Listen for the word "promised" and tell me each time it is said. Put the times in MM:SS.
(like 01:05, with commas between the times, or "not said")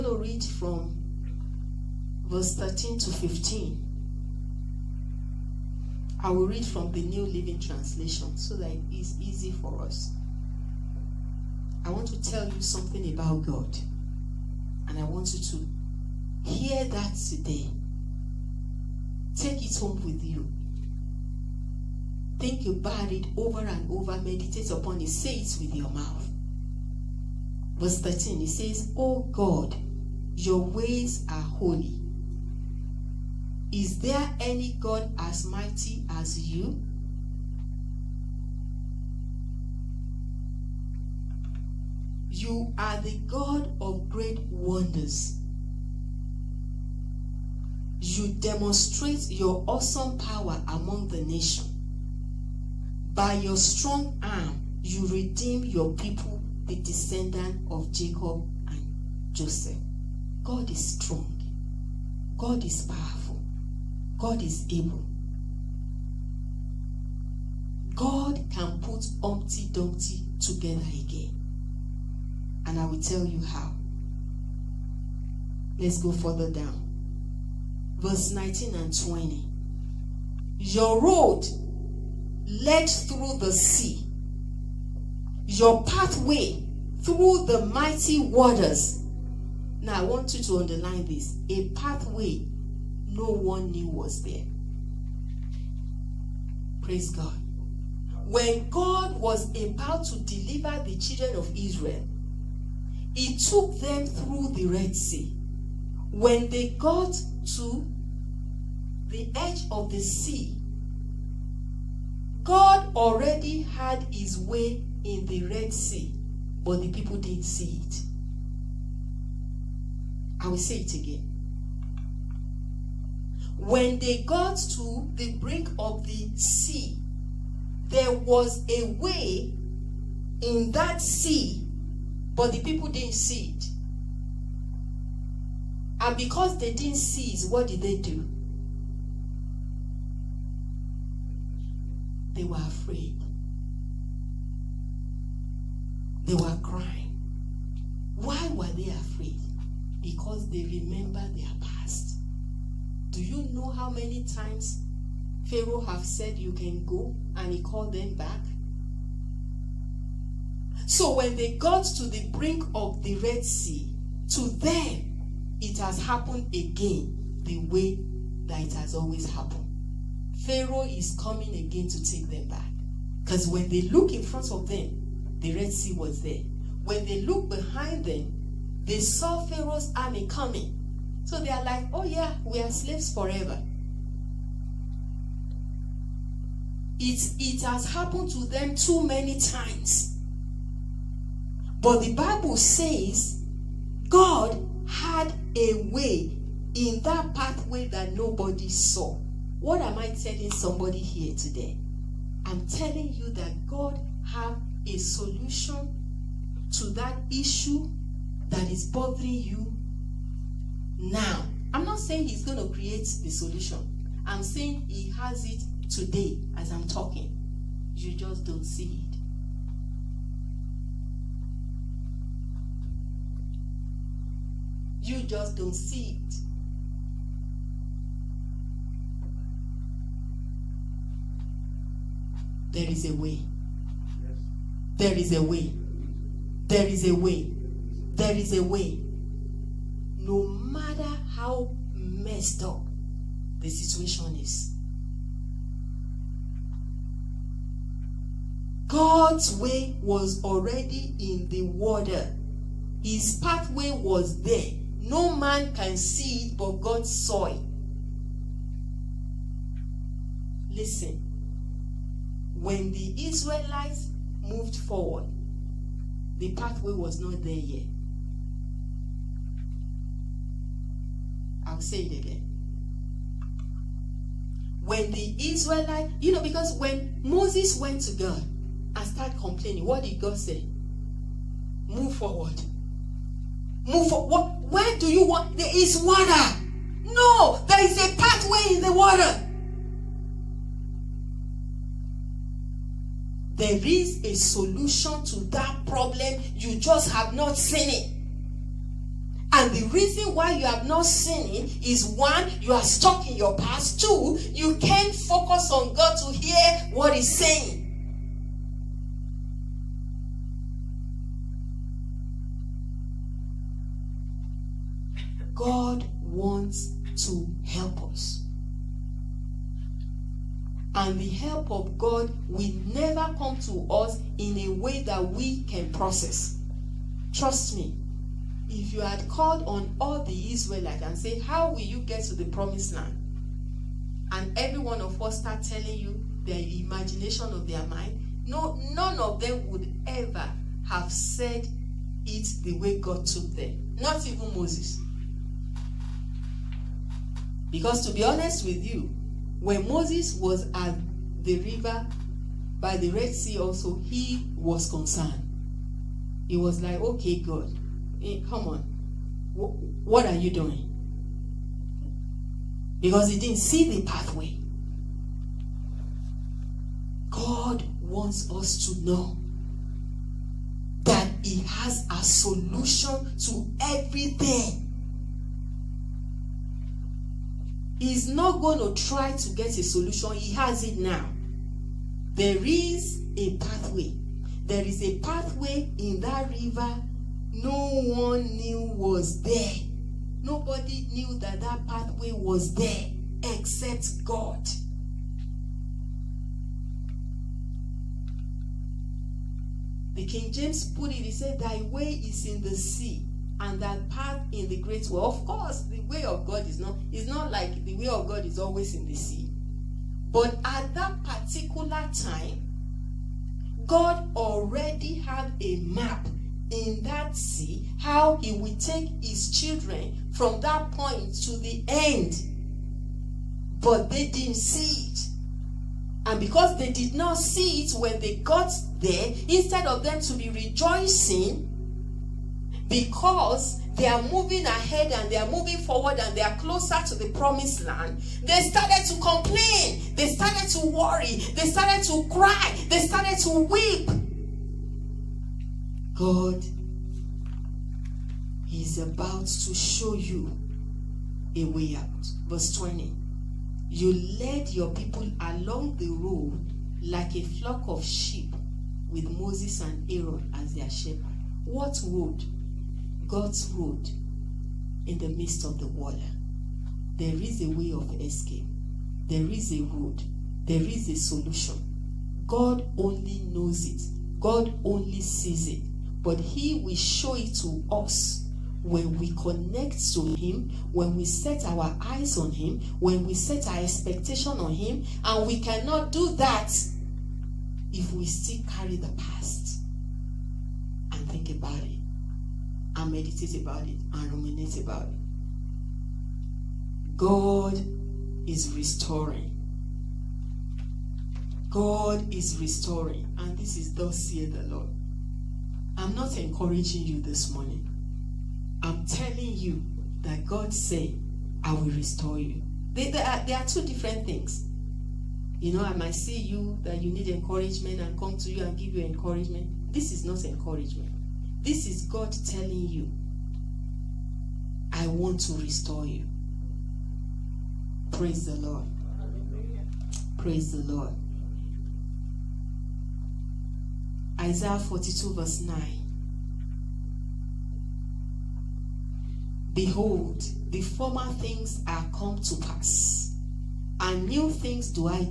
05:32, 07:17.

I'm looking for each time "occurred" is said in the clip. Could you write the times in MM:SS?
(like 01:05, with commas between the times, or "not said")
not said.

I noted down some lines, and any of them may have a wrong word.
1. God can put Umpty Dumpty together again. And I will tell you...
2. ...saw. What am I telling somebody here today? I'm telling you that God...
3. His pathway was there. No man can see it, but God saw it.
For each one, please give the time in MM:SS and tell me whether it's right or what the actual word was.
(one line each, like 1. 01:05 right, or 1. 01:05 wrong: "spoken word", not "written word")
1. 01:07 right
2. 03:18 right
3. 04:13 right.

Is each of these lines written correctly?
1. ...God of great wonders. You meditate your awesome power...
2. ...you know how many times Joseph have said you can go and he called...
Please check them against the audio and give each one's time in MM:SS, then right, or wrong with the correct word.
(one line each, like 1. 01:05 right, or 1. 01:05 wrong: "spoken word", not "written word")
1. 00:43 wrong: "demonstrate", not "meditate"
2. 02:33 wrong: "Pharaoh", not "Joseph".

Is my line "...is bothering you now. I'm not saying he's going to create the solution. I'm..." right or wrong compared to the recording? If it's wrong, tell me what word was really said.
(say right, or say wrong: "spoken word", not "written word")
right.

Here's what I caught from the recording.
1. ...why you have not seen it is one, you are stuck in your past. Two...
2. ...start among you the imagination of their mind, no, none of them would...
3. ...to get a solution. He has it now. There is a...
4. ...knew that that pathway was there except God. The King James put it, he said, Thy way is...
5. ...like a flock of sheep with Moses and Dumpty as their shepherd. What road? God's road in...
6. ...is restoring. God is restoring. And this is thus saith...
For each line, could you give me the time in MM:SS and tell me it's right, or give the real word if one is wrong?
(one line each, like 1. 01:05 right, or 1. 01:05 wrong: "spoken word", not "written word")
1. 05:00 right
2. 05:35 wrong: "telling", not "among"
3. 06:19 right
4. 06:31 right
5. 07:37 wrong: "Aaron", not "Dumpty"
6. 08:18 right.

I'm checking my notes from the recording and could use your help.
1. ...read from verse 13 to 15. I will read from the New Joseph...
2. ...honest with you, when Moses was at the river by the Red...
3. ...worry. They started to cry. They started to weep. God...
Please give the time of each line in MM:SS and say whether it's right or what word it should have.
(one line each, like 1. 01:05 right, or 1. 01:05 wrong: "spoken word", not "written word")
1. 00:00 wrong: "Living", not "Joseph"
2. 05:48 right
3. 07:20 right.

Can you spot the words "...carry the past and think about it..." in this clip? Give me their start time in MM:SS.
08:08.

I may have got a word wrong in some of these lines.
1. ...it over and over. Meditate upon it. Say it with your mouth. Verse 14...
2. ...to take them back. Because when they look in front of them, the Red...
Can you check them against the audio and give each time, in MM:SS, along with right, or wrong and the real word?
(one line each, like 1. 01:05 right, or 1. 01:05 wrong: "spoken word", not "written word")
1. 00:23 wrong: "13", not "14"
2. 02:51 right.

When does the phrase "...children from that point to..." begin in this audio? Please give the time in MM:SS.
06:59.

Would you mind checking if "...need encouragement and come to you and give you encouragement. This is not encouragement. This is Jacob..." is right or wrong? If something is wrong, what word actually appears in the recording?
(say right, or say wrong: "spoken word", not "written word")
wrong: "God", not "Jacob".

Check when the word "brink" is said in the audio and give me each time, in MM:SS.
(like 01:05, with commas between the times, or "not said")
02:05, 02:42.